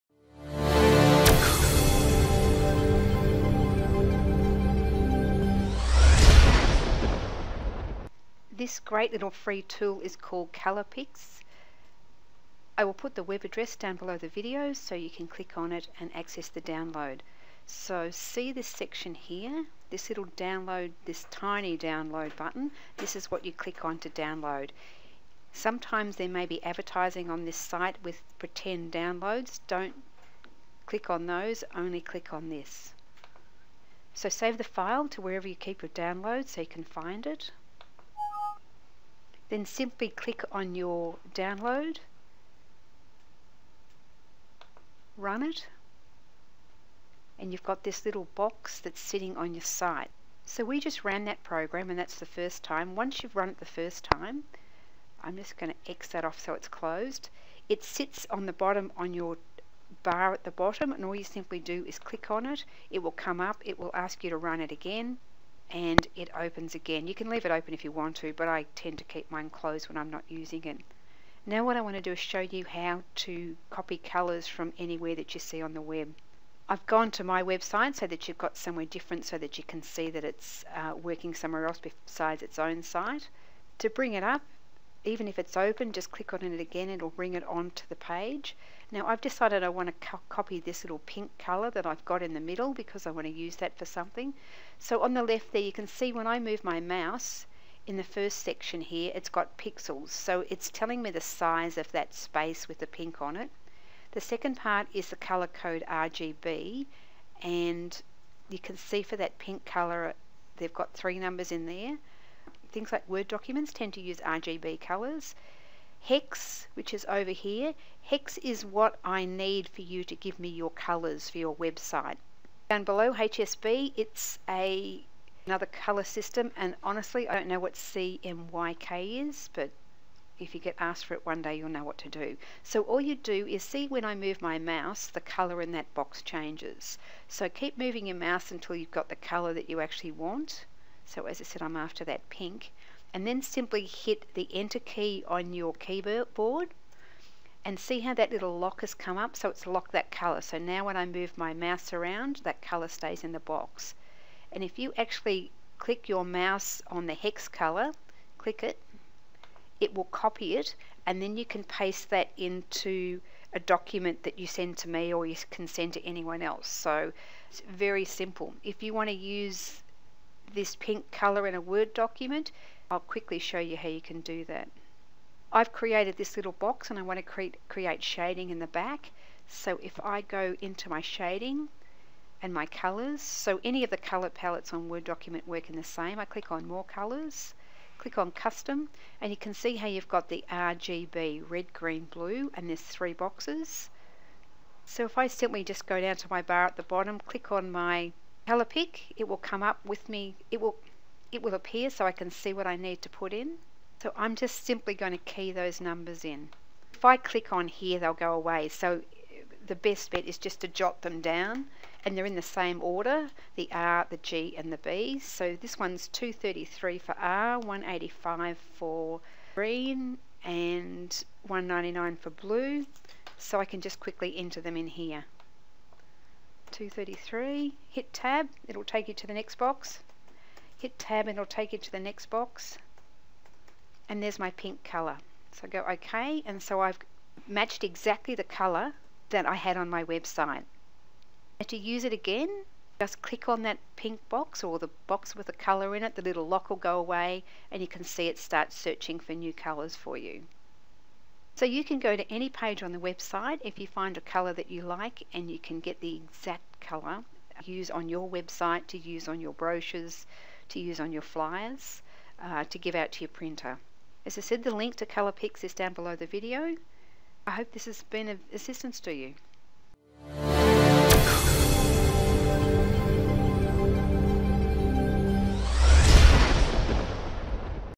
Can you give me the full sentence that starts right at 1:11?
Now what I want to do is show you how to copy colours from anywhere that you see on the web.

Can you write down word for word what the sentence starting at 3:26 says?
If I click on here, they'll go away.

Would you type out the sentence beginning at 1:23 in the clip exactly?
To bring it up, even if it's open, just click on it again, it'll bring it onto the page.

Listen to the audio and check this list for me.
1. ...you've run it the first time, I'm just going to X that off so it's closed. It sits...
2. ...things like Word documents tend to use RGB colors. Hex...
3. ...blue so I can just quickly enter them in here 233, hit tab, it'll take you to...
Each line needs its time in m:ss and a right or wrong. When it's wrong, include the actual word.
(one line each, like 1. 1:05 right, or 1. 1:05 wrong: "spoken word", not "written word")
1. 0:53 right
2. 1:52 right
3. 3:42 right.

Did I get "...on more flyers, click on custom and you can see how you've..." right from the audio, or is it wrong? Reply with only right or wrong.
wrong.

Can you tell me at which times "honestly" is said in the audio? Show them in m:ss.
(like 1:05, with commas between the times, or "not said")
2:06.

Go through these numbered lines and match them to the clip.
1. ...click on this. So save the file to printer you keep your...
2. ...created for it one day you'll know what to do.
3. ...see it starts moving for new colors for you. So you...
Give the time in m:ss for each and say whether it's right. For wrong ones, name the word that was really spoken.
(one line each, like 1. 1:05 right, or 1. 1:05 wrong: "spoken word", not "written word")
1. 0:31 wrong: "wherever", not "printer"
2. 2:10 wrong: "asked", not "created"
3. 4:08 wrong: "searching", not "moving".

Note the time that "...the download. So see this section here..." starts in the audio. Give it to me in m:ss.
0:16.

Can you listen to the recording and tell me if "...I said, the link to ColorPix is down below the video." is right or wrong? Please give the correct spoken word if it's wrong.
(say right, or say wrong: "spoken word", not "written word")
right.